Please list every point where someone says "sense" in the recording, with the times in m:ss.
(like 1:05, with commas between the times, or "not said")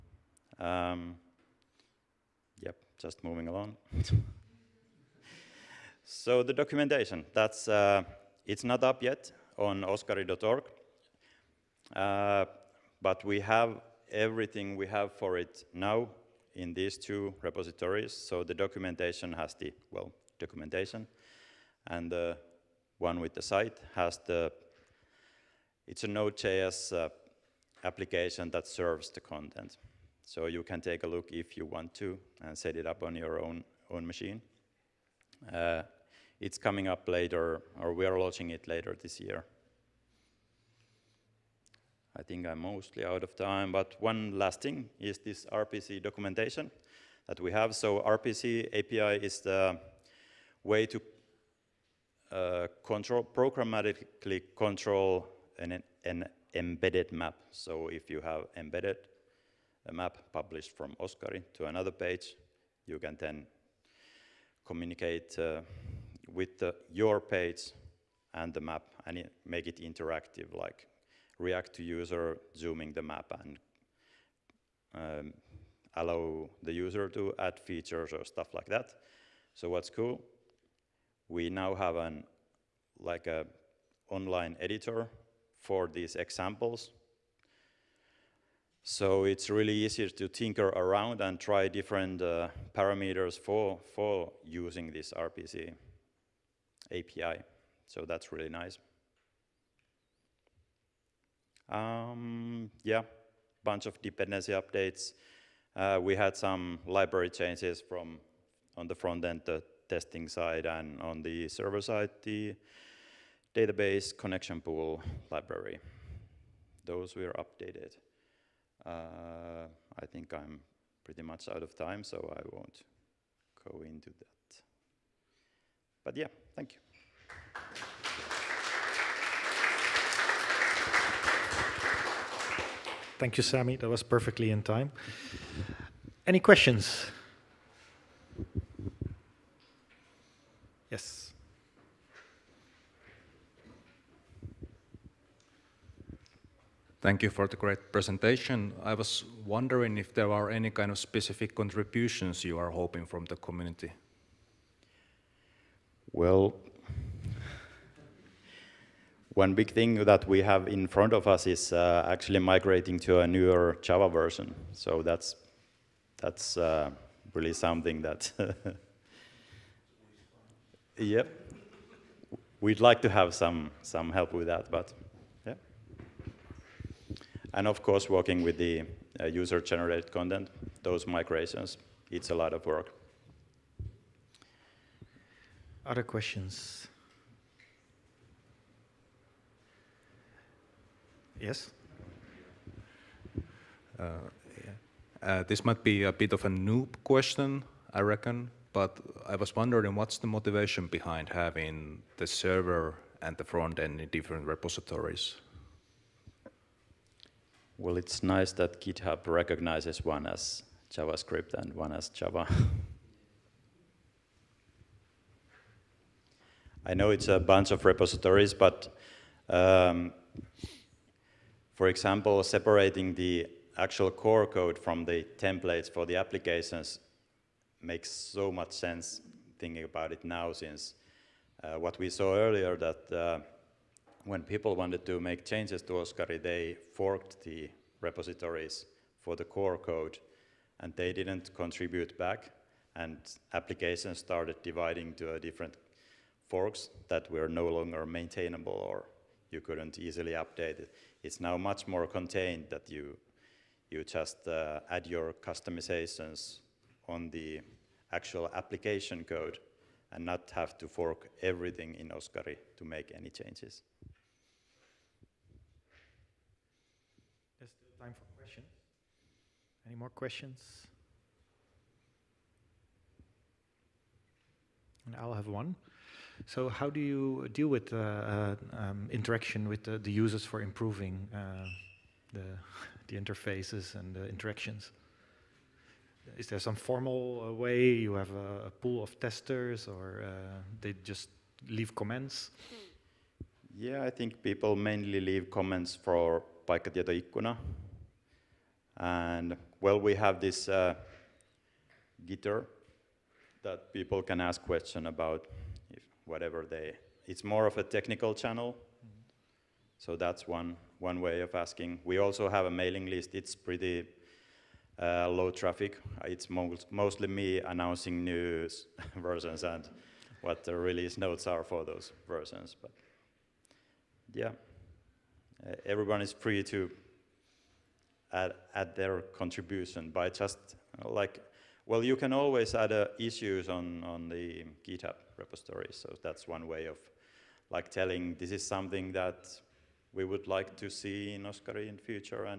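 3:48.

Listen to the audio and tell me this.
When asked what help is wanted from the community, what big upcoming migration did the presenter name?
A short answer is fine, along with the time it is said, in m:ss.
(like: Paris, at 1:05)
newer Java version, at 2:43.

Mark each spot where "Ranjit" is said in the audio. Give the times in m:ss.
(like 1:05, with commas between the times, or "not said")
not said.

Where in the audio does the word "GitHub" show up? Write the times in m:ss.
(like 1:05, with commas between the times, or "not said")
3:28, 5:34.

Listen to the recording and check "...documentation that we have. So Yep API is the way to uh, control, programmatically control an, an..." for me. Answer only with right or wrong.
wrong.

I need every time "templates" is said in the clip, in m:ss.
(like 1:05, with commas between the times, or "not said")
3:45.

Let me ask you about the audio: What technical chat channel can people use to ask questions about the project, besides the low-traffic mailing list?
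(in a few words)
Gitter.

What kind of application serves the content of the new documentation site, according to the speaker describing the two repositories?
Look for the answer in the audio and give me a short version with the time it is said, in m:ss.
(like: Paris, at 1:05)
Node.js, at 0:26.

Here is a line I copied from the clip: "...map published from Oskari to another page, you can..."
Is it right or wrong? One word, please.
right.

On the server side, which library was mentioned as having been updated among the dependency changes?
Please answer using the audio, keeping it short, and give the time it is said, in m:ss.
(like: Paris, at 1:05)
database connection pool library, at 1:53.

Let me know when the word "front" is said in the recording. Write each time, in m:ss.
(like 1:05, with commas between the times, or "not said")
1:48, 2:40, 3:23.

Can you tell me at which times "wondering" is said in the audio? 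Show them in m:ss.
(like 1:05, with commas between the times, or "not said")
2:29, 3:19.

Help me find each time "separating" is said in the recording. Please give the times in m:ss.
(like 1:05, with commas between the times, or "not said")
3:42.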